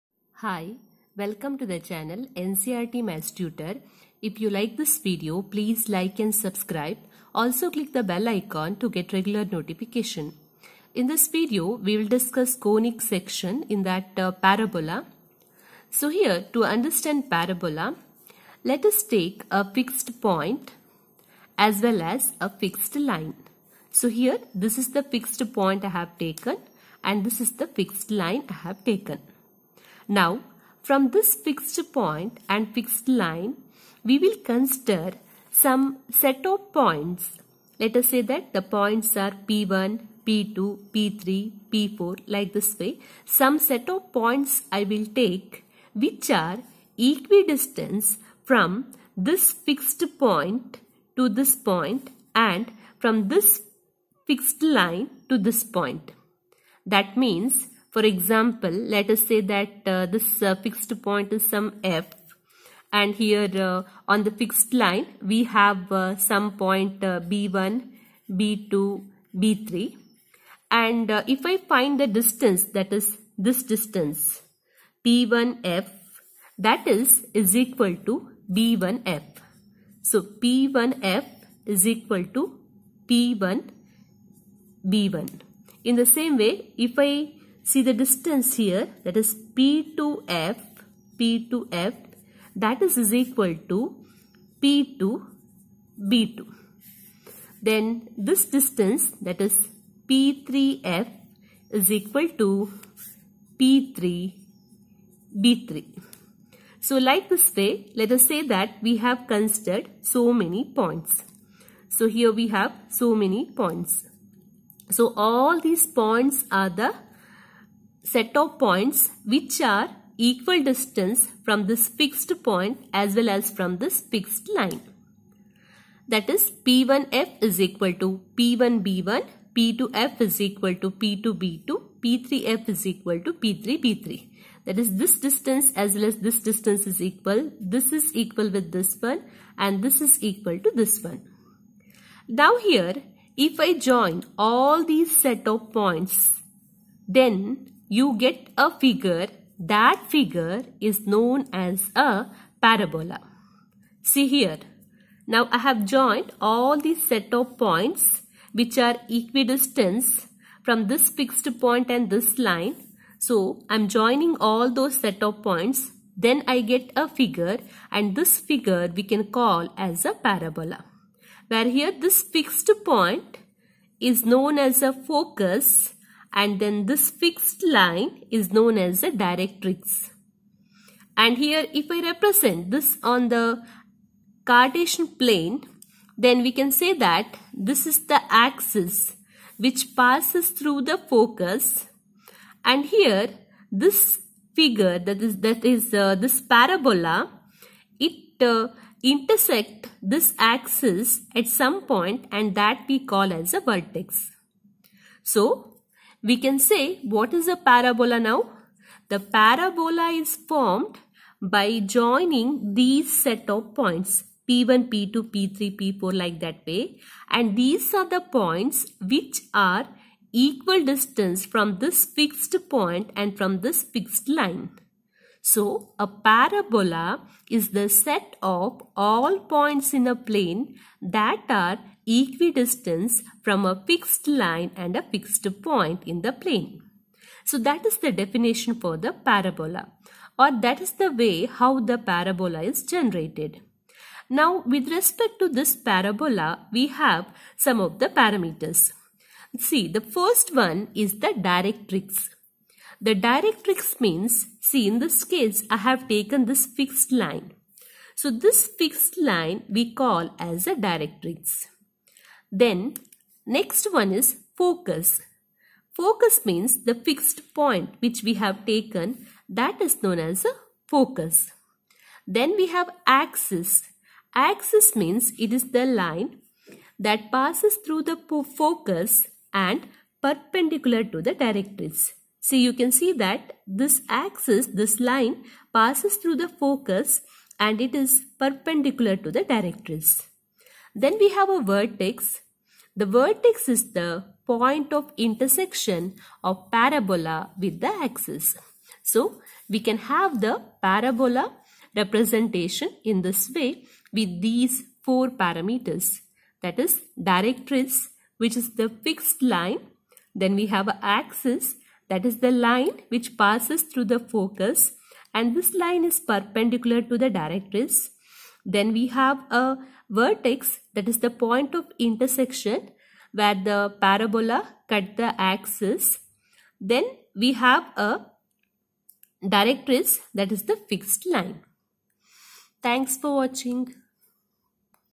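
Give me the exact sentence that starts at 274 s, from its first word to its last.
Axis means it is the line that passes through the focus and perpendicular to the directrix.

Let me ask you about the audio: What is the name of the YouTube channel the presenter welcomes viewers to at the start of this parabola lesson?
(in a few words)
NCERT Maths Tutor.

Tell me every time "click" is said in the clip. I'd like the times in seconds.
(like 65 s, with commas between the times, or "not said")
7 s.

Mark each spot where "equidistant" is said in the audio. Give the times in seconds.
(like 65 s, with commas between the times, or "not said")
46 s, 159 s, 232 s.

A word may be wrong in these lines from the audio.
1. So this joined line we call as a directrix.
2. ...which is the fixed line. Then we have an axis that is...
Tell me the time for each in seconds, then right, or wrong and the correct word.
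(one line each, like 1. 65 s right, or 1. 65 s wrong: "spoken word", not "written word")
1. 258 s wrong: "fixed", not "joined"
2. 308 s right.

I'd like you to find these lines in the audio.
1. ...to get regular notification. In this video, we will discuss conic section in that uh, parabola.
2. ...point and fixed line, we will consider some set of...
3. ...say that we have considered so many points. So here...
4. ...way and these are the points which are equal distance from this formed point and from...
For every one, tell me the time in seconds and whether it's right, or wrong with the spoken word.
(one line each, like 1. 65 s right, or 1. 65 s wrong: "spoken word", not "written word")
1. 8 s right
2. 31 s right
3. 108 s right
4. 216 s wrong: "fixed", not "formed".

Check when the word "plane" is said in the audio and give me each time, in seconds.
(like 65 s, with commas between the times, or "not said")
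185 s, 230 s, 236 s.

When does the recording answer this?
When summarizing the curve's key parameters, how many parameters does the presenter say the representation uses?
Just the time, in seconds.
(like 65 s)
305 s.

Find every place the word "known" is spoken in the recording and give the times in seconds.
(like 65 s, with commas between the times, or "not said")
151 s, 174 s, 178 s, 270 s.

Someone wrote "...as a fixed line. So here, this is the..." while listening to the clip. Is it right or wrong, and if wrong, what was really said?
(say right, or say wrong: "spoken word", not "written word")
right.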